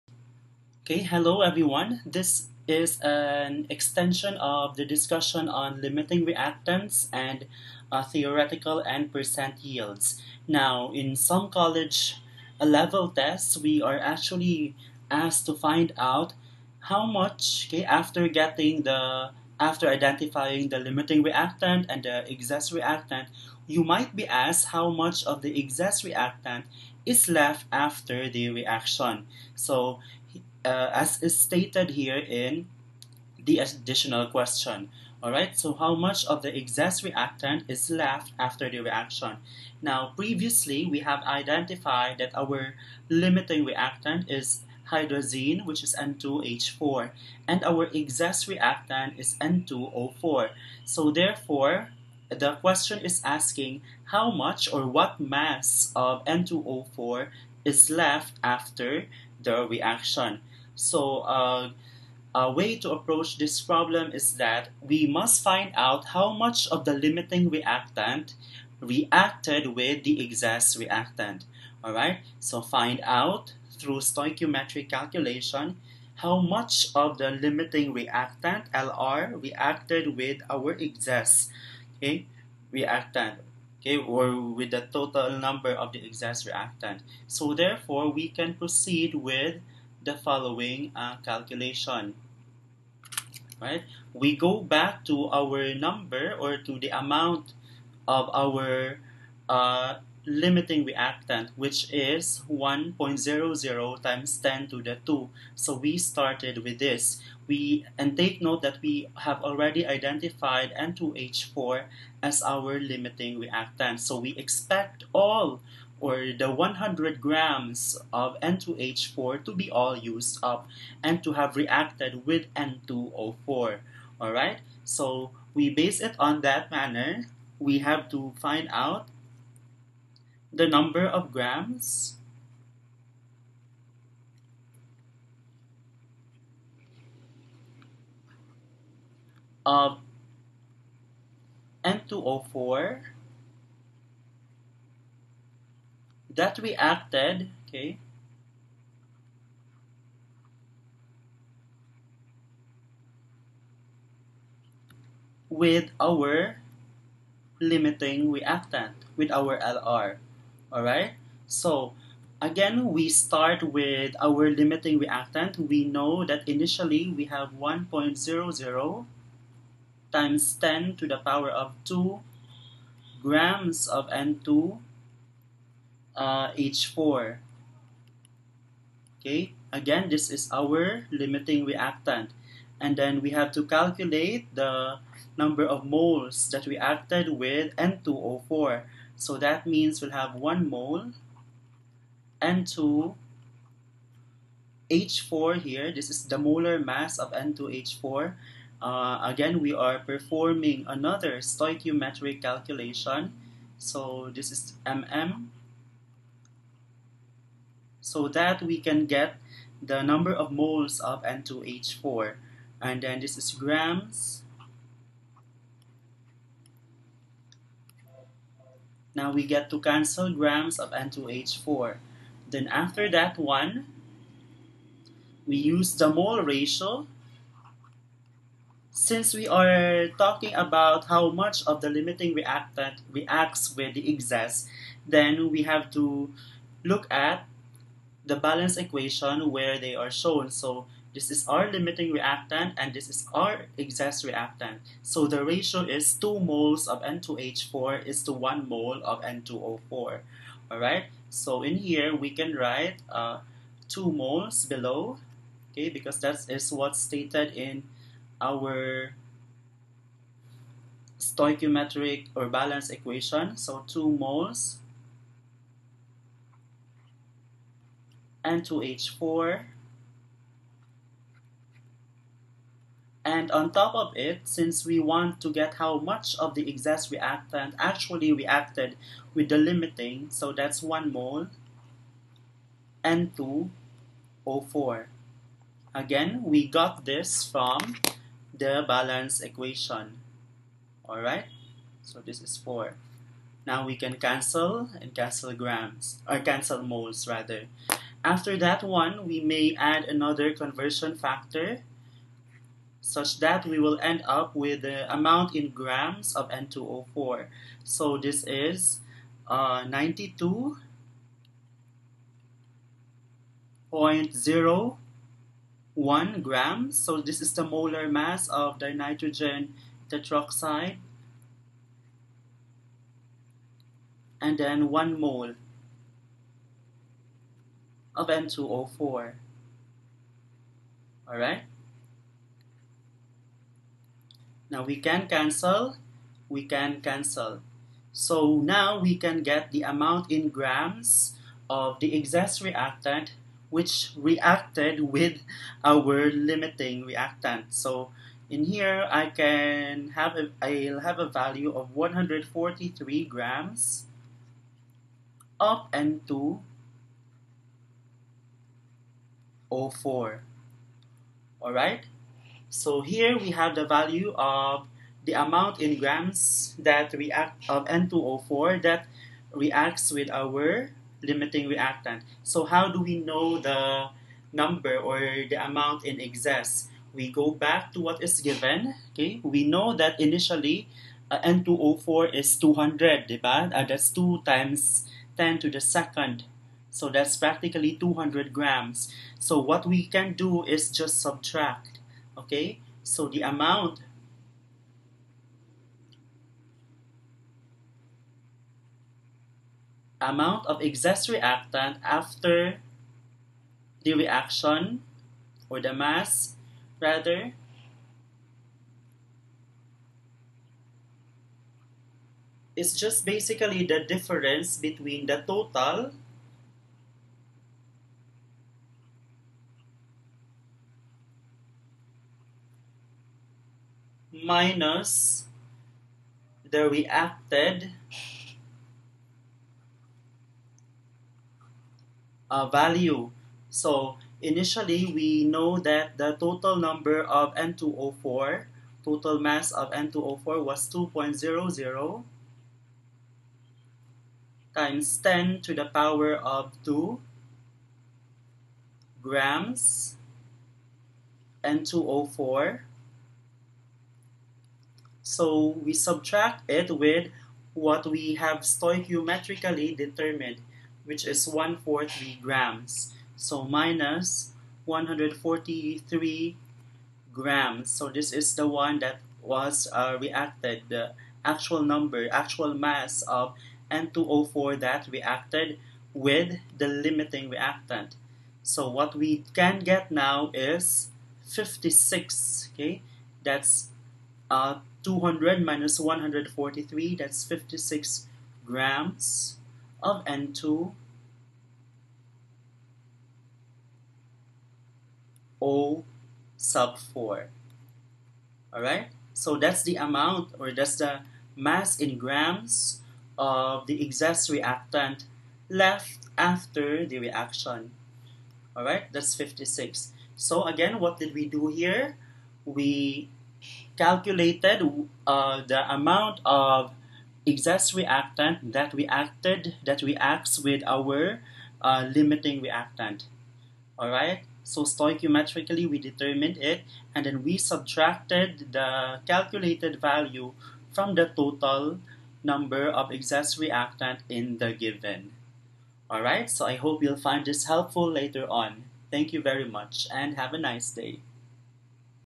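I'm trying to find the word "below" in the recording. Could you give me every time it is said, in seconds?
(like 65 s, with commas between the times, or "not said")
254 s.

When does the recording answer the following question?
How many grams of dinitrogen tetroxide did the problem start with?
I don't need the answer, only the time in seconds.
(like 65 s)
387 s.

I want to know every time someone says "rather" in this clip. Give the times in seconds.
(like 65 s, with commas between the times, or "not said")
297 s, 406 s.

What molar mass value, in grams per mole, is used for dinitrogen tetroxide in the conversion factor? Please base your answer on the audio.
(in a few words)
92.01 grams.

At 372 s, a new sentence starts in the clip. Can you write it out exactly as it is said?
So how do we know the number or the amount in excess?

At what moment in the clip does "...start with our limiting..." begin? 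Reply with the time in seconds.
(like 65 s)
163 s.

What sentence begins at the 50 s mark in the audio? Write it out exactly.
So therefore, the question is asking how much or what mass of N2O4 is left after the reaction.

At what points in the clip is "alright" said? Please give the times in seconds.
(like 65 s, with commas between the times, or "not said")
35 s, 160 s, 250 s, 291 s, 331 s, 498 s, 508 s, 536 s.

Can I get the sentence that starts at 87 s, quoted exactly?
So therefore, we can proceed with the following uh, calculation.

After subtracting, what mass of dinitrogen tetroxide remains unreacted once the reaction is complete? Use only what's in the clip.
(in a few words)
56 grams.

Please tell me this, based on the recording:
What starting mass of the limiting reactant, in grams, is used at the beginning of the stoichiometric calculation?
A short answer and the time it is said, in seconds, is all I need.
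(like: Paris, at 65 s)
100 grams, at 116 s.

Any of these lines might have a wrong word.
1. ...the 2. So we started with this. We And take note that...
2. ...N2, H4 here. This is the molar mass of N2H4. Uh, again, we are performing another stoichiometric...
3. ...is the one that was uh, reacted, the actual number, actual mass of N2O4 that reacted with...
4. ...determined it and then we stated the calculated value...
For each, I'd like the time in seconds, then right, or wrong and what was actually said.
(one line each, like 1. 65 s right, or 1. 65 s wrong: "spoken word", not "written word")
1. 104 s right
2. 192 s right
3. 468 s right
4. 525 s wrong: "subtracted", not "stated".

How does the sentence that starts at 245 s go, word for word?
So the ratio is 2 moles of N2H4 is to 1 mole of N2O4.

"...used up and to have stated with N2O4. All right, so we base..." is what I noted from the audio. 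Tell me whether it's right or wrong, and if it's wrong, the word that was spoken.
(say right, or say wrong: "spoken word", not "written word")
wrong: "reacted", not "stated".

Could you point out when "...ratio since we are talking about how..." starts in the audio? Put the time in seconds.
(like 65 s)
226 s.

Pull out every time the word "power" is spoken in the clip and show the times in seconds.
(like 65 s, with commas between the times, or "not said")
171 s, 445 s.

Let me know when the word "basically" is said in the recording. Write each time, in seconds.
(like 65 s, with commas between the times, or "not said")
413 s.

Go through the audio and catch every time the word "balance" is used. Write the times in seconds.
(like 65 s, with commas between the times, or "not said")
238 s, 262 s, 288 s.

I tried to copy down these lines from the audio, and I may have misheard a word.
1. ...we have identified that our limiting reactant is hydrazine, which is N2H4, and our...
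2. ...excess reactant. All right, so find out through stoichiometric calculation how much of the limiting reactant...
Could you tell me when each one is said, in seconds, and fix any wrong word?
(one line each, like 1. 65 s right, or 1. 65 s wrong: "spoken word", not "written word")
1. 40 s right
2. 70 s right.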